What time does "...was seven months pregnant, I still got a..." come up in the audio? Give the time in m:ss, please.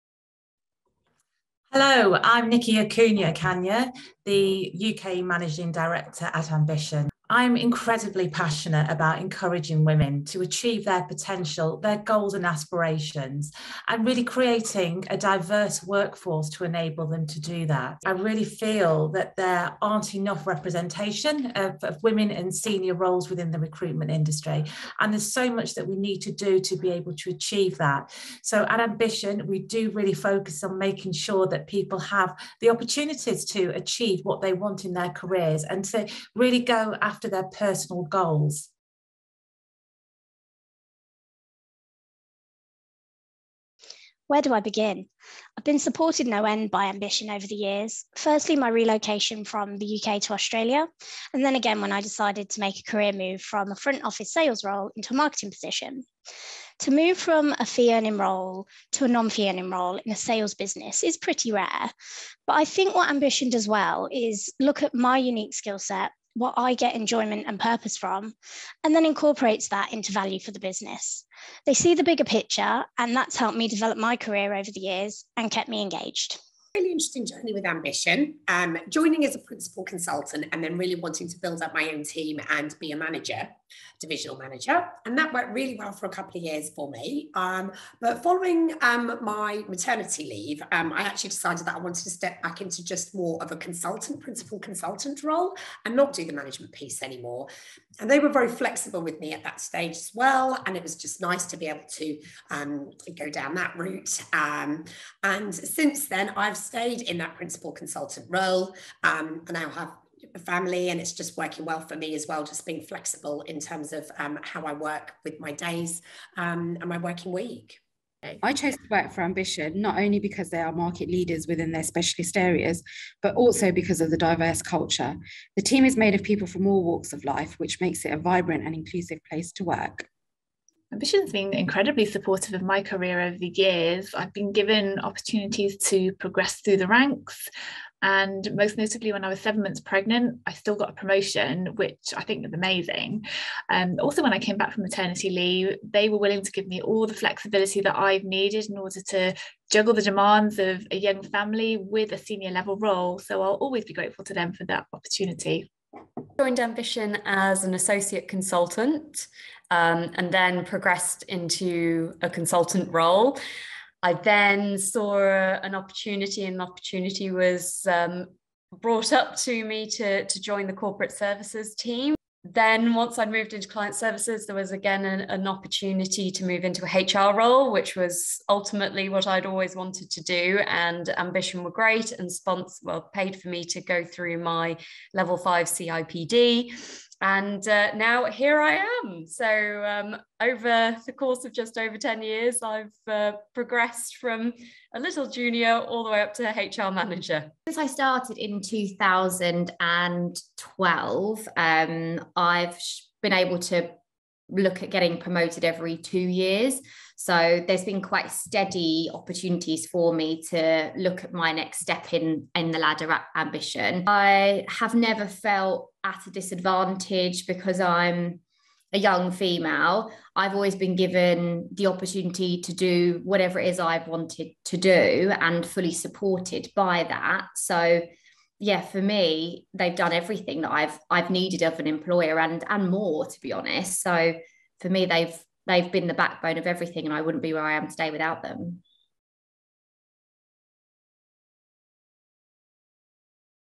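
2:19.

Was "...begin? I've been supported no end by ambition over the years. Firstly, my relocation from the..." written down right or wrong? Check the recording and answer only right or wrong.
right.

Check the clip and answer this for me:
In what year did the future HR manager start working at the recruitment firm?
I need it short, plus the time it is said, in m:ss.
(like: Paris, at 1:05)
2012, at 3:18.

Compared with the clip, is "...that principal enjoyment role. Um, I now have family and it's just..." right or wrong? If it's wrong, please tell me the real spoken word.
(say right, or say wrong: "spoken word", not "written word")
wrong: "consultant", not "enjoyment".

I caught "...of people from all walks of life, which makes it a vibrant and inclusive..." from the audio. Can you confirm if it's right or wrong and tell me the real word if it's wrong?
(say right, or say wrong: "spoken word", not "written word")
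right.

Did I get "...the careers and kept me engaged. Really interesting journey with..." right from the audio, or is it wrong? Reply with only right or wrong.
wrong.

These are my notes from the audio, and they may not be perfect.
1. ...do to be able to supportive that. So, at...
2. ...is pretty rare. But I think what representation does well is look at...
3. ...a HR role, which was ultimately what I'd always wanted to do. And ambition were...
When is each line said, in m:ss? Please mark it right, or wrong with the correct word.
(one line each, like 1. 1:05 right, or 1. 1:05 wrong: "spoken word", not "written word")
1. 0:26 wrong: "achieve", not "supportive"
2. 1:01 wrong: "ambition", not "representation"
3. 2:56 right.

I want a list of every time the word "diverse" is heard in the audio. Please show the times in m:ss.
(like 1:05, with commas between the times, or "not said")
0:15, 2:04.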